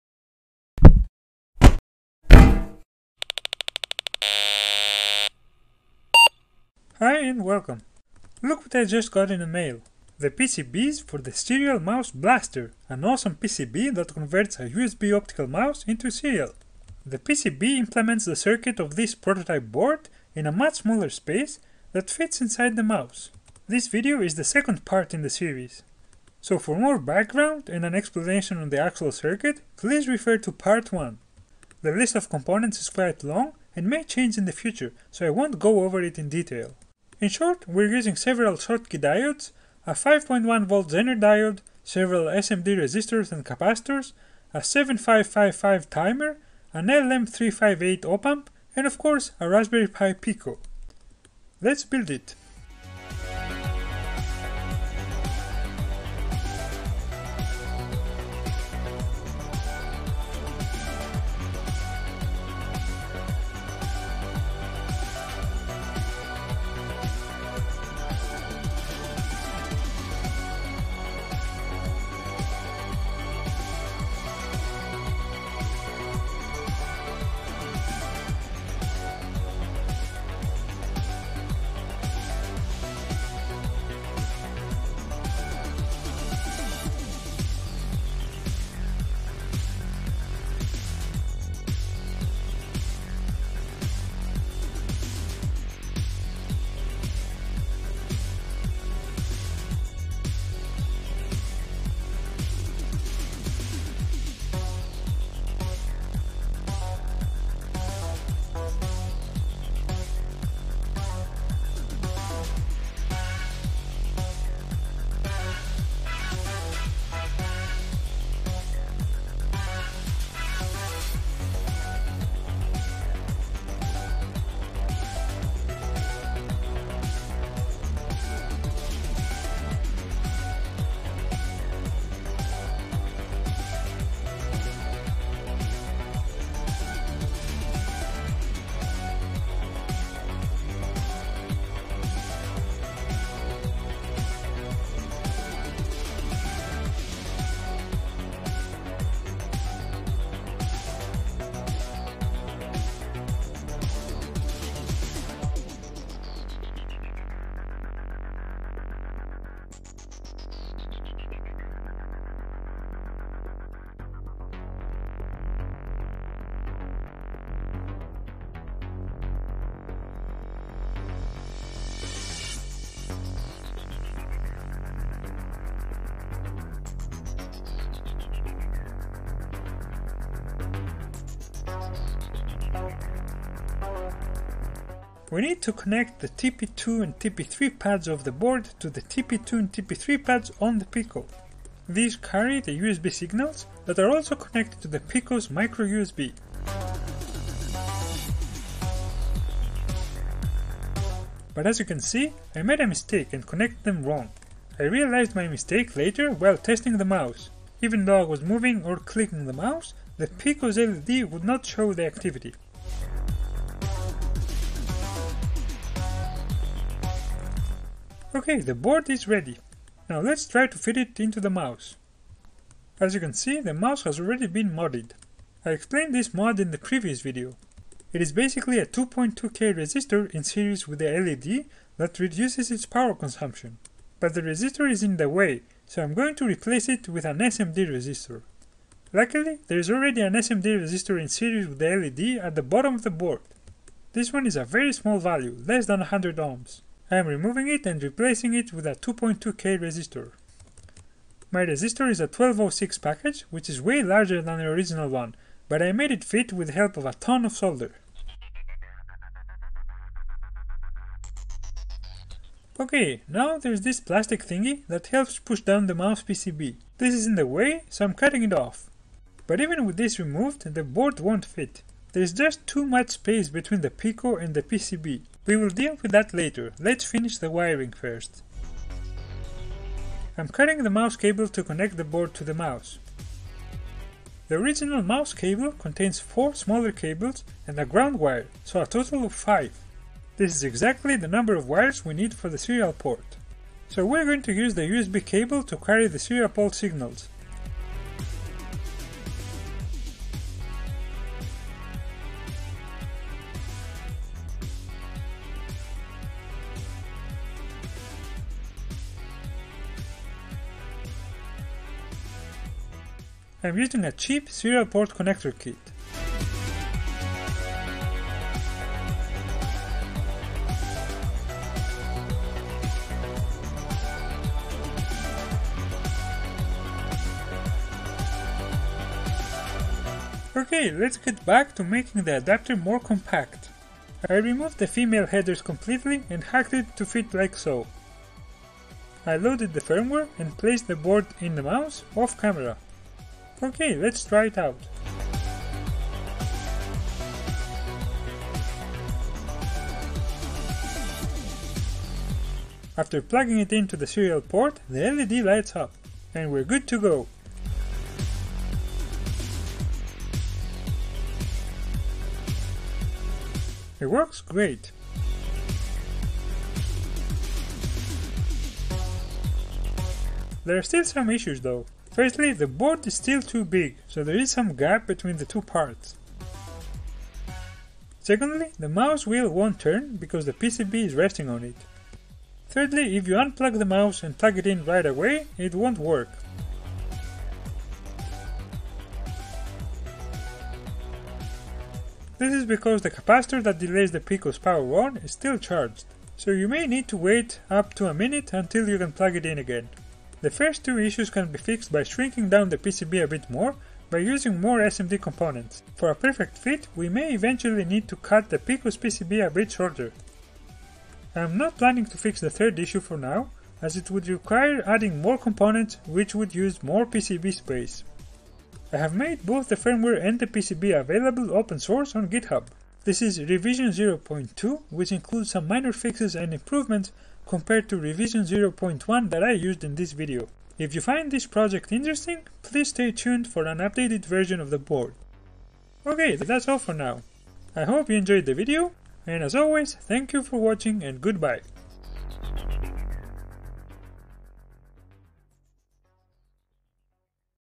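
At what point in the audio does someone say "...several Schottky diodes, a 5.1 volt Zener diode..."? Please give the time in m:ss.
0:38.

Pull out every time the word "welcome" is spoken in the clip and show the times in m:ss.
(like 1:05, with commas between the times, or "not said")
0:07.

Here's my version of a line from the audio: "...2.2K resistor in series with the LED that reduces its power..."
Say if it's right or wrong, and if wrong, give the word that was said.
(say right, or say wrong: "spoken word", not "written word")
right.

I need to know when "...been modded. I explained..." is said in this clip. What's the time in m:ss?
3:44.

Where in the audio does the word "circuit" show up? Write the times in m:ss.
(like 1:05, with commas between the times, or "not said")
0:18, 0:29.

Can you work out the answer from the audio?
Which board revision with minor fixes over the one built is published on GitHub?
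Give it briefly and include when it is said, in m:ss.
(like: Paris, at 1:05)
0.2, at 7:03.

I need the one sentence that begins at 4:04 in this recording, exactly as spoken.
This one is a very small value, less than 100 ohms.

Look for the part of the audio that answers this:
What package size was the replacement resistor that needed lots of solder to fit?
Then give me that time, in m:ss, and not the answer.
4:12.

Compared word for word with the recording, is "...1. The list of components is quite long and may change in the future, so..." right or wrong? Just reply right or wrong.
right.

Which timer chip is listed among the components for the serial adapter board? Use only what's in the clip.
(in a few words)
7555.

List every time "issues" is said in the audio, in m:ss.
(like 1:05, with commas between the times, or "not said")
6:11, 6:40, 6:52.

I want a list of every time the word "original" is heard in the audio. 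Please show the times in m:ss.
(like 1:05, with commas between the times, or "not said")
4:14, 4:44.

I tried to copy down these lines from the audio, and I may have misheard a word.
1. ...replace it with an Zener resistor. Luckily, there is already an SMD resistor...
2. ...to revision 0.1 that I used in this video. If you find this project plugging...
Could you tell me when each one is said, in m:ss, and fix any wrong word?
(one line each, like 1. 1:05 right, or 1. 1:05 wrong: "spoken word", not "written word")
1. 3:56 wrong: "SMD", not "Zener"
2. 7:07 wrong: "interesting", not "plugging".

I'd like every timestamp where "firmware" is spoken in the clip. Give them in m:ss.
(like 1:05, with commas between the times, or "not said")
5:39, 6:59.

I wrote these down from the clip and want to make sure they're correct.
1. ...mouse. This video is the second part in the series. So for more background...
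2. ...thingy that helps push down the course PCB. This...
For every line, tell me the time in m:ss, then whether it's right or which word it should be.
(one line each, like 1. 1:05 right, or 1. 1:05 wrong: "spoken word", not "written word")
1. 0:22 right
2. 4:24 wrong: "mouse", not "course".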